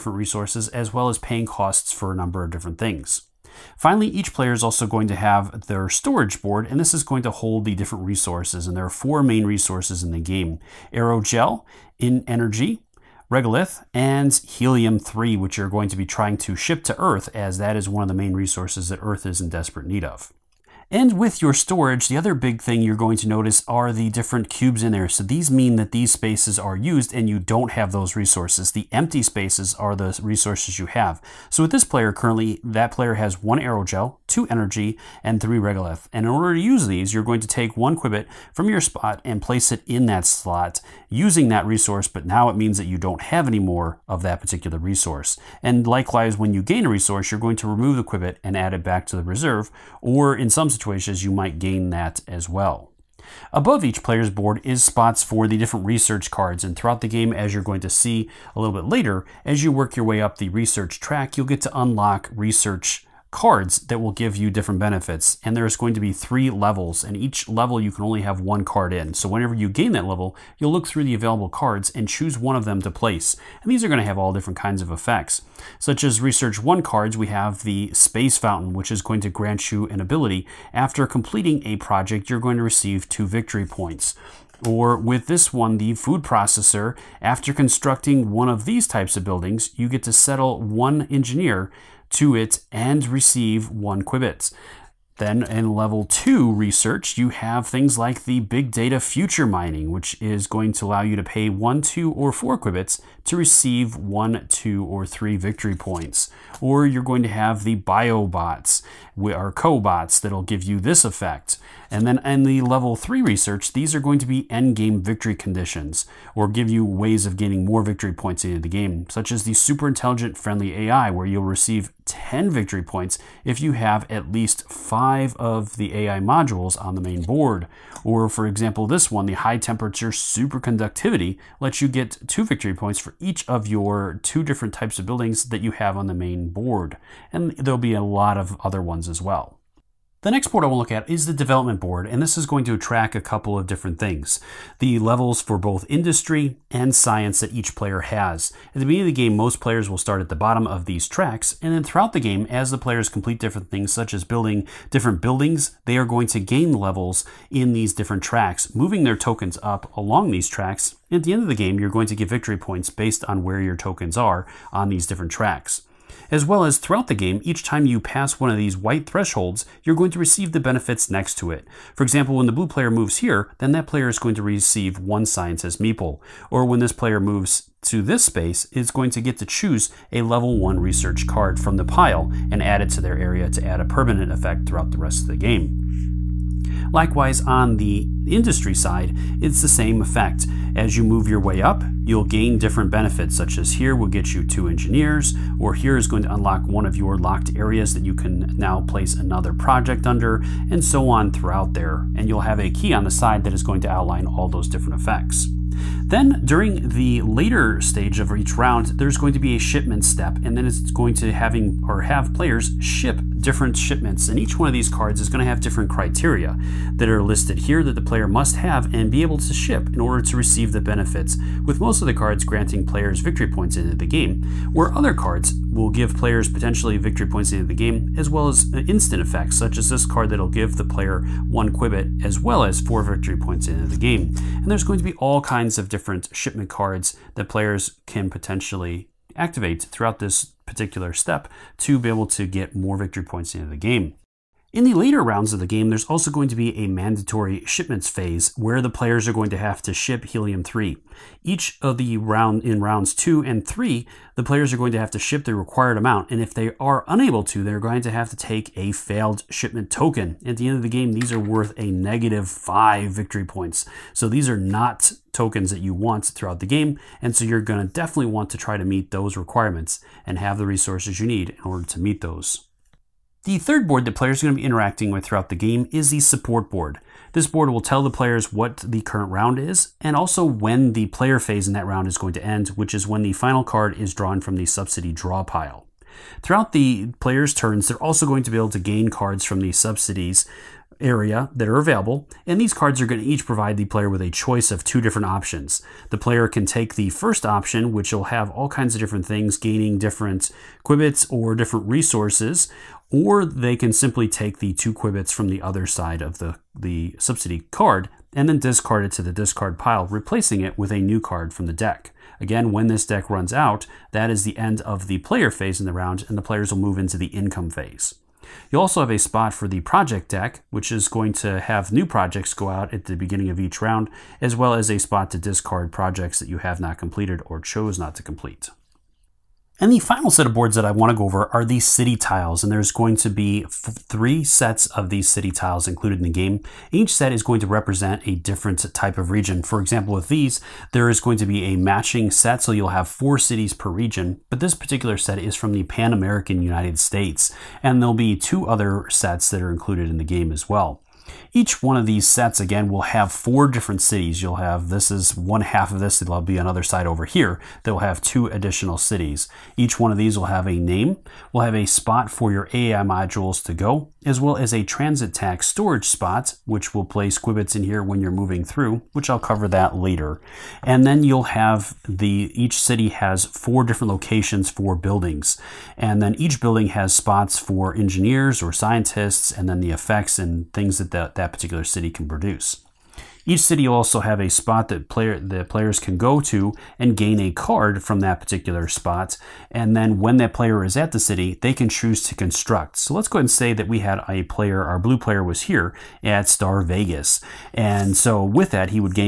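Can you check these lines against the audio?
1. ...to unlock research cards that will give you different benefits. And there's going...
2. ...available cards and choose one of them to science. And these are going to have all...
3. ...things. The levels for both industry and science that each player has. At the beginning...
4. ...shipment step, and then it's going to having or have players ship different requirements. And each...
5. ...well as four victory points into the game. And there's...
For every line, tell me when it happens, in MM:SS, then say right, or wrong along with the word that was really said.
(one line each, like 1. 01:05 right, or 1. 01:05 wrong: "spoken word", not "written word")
1. 01:01 right
2. 01:11 wrong: "place", not "science"
3. 02:23 right
4. 03:29 wrong: "shipments", not "requirements"
5. 03:52 right.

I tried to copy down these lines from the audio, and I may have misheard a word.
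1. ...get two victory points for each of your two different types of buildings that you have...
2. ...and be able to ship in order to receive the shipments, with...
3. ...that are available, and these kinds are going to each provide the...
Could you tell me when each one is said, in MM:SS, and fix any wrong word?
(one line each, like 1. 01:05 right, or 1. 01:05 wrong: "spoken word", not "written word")
1. 02:11 right
2. 03:38 wrong: "benefits", not "shipments"
3. 04:51 wrong: "cards", not "kinds".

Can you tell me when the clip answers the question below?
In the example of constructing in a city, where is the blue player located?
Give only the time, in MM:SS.
06:36.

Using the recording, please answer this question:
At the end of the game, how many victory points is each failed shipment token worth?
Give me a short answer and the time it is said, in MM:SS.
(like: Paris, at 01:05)
-5, at 04:21.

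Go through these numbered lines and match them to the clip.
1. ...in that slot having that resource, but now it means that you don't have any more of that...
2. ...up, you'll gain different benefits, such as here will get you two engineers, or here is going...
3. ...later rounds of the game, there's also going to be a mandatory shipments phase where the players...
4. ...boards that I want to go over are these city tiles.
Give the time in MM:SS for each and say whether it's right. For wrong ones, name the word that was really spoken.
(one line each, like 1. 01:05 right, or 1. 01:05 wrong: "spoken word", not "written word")
1. 00:39 wrong: "using", not "having"
2. 03:11 right
3. 04:04 right
4. 05:30 right.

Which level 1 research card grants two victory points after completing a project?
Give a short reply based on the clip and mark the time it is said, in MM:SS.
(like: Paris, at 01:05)
Space Fountain, at 01:17.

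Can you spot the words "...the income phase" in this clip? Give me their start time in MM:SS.
05:17.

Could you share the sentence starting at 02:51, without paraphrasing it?
For example, when the blue player moves here, then that player is going to receive one science as Meeple.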